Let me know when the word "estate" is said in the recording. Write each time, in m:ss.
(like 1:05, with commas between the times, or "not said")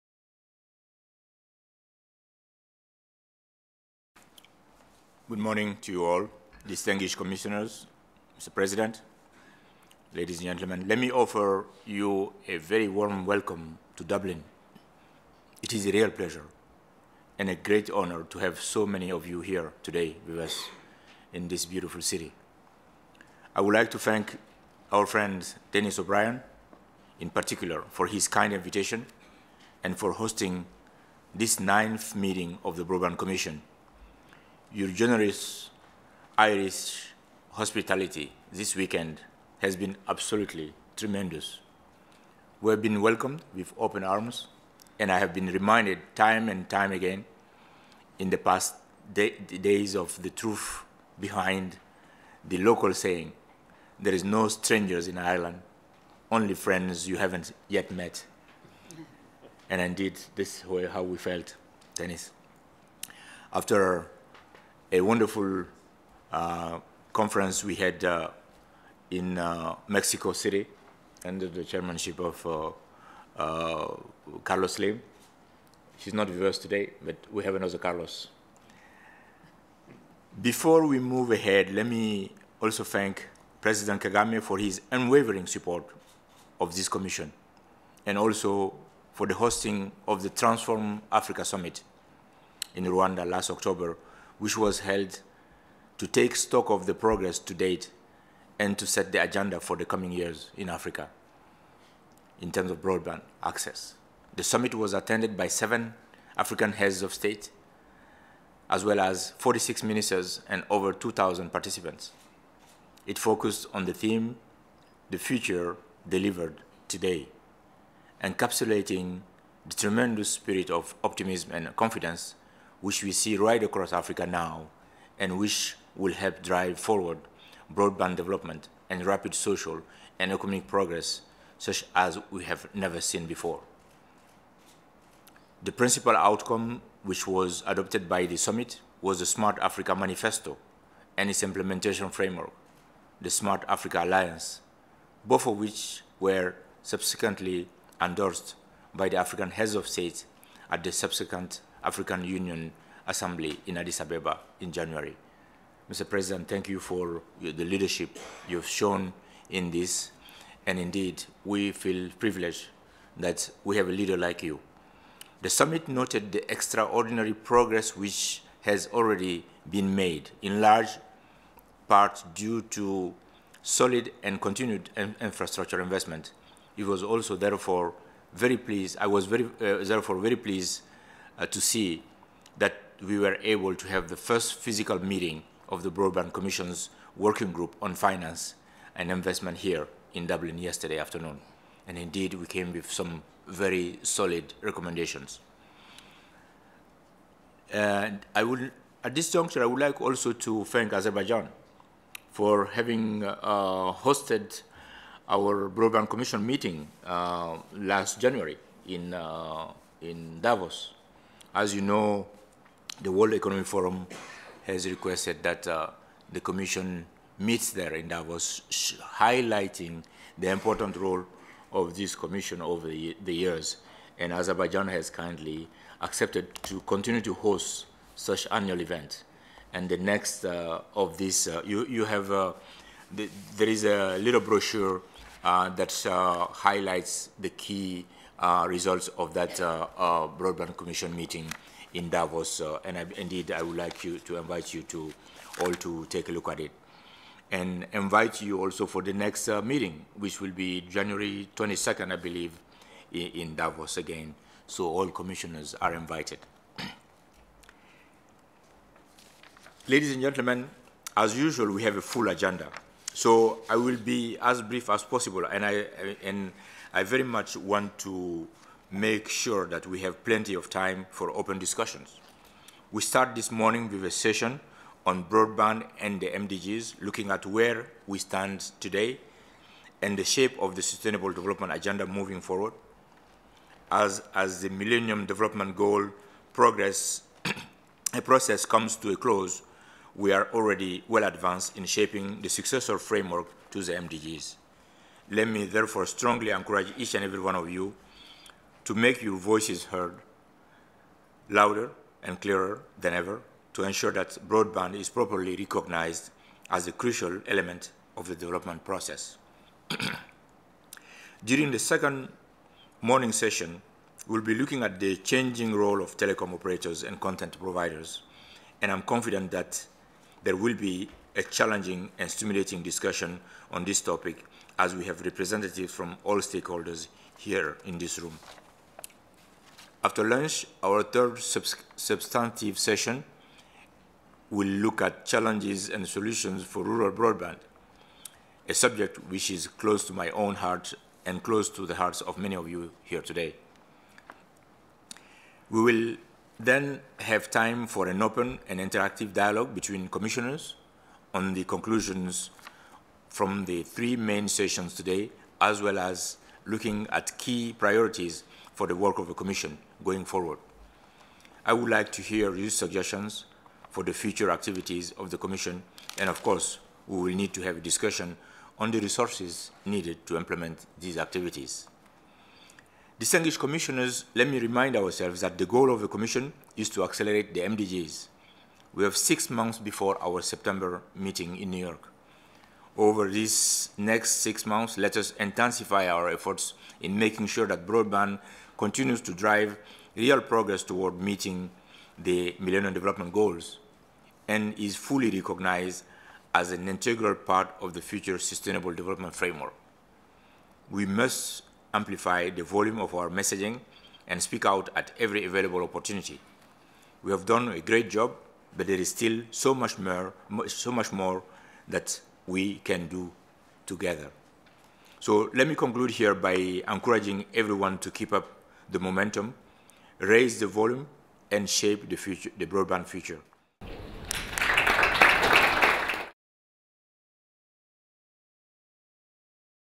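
not said.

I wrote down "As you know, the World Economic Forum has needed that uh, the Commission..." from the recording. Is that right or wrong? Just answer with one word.
wrong.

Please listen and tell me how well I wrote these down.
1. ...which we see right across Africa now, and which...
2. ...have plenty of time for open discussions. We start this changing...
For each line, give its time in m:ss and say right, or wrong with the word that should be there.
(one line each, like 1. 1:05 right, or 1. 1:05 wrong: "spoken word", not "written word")
1. 2:02 right
2. 4:30 wrong: "morning", not "changing".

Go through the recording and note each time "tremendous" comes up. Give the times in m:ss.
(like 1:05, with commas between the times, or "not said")
0:40, 1:59.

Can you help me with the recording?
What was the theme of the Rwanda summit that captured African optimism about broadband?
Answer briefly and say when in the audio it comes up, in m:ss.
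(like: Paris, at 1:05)
the future delivered today, at 1:55.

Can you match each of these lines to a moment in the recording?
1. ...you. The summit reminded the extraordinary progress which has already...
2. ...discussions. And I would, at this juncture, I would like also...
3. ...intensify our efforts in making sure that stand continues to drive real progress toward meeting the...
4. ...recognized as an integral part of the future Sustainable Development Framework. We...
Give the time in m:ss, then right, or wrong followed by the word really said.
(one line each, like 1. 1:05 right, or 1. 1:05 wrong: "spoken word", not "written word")
1. 2:44 wrong: "noted", not "reminded"
2. 3:14 wrong: "recommendations", not "discussions"
3. 6:25 wrong: "broadband", not "stand"
4. 6:35 right.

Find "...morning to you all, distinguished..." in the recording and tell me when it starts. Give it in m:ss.
0:05.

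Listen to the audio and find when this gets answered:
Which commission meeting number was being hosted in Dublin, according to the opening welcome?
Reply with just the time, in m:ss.
0:31.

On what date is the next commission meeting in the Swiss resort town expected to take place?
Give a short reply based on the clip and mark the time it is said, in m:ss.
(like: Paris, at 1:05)
January 22, at 4:10.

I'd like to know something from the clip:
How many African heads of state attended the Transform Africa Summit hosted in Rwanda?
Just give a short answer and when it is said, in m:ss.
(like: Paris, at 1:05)
7, at 1:45.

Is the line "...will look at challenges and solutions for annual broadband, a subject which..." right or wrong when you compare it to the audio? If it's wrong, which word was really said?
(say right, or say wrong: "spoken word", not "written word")
wrong: "rural", not "annual".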